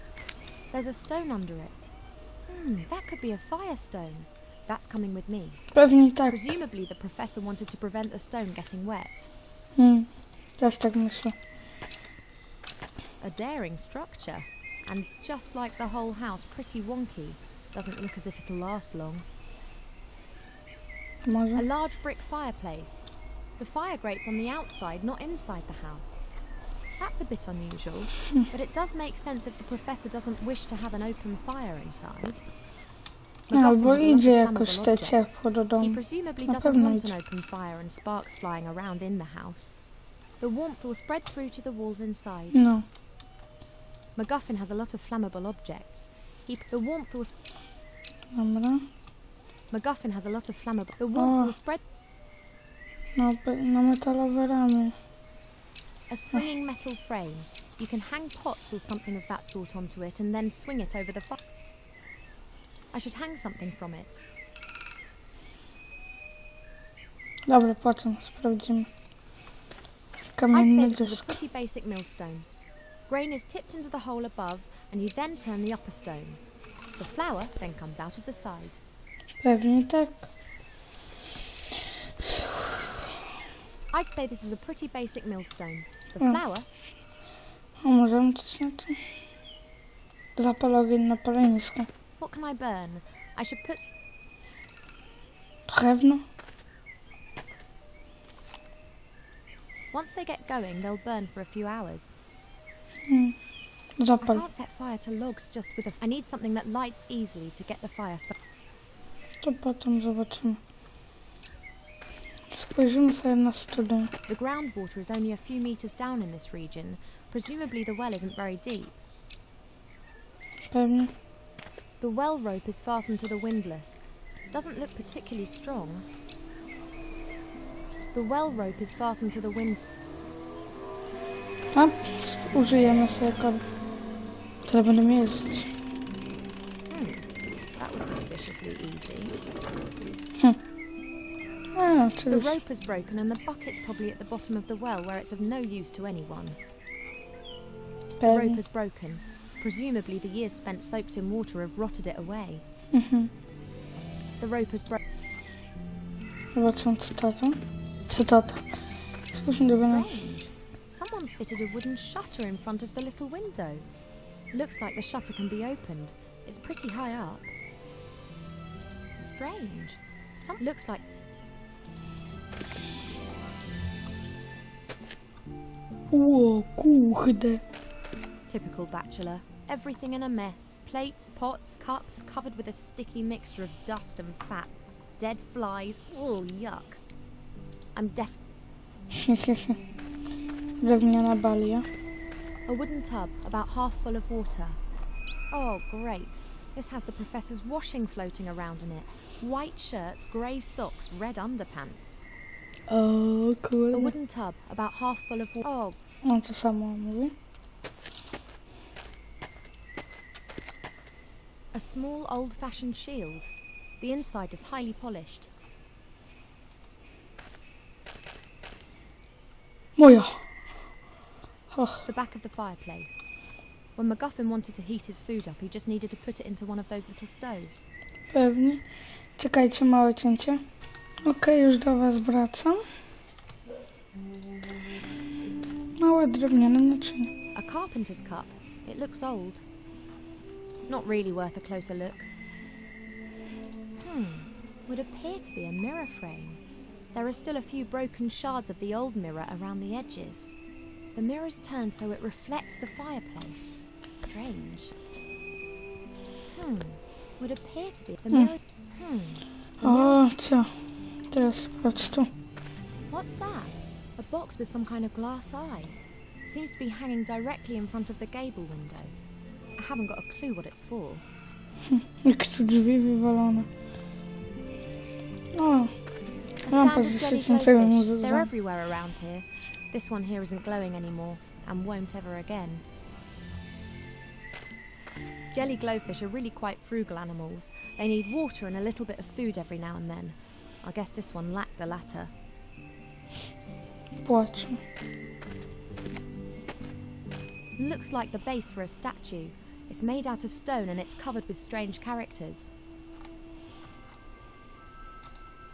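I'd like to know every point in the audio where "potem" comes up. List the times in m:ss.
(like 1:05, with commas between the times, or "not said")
1:07, 1:49.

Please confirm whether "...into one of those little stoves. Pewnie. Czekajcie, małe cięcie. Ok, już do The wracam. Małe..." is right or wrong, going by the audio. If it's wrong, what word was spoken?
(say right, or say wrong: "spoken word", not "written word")
wrong: "Was", not "The".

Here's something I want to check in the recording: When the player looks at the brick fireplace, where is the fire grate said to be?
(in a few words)
outside.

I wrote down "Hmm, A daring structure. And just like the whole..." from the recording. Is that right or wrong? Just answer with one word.
right.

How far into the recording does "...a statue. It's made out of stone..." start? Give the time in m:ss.
4:58.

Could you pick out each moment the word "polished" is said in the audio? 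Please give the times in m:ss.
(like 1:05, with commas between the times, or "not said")
3:34.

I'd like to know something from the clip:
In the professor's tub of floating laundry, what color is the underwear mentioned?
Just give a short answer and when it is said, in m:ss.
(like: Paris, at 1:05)
red, at 3:21.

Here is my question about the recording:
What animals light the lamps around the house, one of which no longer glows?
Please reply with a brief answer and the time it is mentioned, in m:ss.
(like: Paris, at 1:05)
jelly glowfish, at 4:45.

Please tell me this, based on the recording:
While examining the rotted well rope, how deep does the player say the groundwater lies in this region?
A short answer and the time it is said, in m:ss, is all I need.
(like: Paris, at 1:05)
a few meters, at 1:55.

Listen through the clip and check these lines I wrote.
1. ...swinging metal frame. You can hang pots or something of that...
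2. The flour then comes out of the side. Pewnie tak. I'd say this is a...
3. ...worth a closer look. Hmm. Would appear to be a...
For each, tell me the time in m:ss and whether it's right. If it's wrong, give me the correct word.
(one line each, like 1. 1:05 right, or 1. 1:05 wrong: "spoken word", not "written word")
1. 0:56 right
2. 1:16 right
3. 4:01 right.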